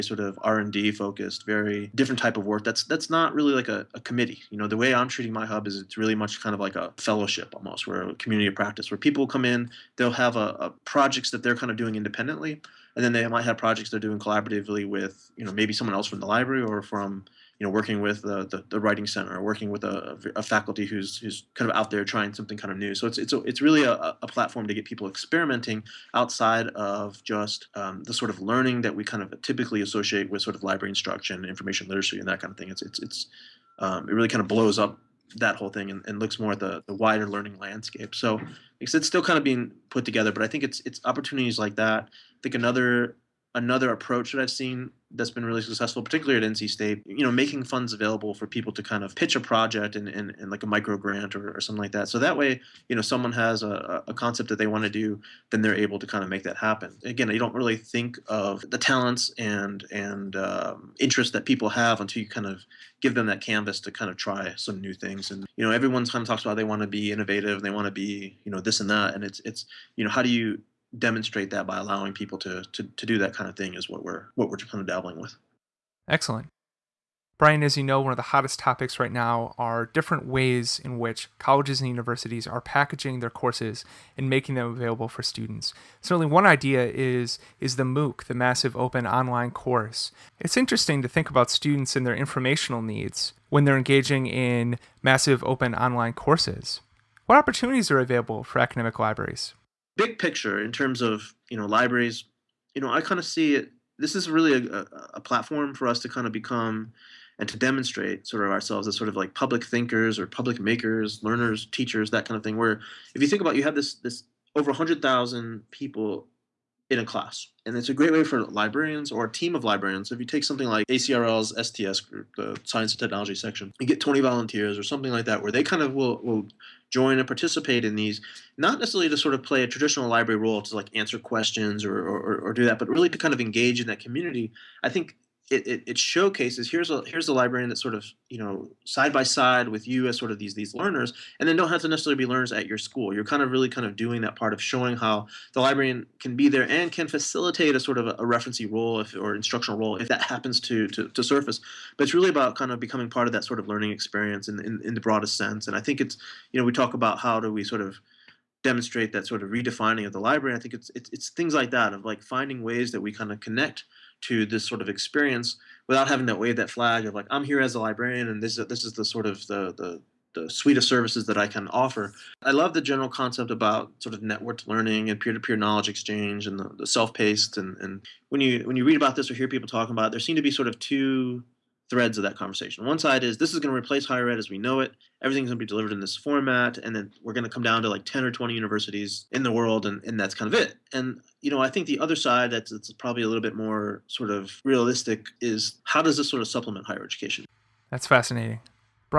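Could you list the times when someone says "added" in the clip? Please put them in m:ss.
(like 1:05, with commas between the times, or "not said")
not said.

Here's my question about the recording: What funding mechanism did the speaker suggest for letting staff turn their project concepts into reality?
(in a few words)
micro grant.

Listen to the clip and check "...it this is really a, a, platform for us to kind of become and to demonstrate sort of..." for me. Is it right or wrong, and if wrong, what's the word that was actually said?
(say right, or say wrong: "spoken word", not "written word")
right.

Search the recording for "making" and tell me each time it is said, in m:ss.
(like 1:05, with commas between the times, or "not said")
0:47, 1:24.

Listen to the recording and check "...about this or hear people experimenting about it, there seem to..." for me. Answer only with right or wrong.
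wrong.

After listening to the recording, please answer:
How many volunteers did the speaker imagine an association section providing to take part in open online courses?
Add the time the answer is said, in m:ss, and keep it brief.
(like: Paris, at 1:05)
20, at 2:04.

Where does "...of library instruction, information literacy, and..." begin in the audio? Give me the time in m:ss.
0:30.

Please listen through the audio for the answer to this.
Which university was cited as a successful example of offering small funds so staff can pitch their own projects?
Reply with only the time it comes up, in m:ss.
0:46.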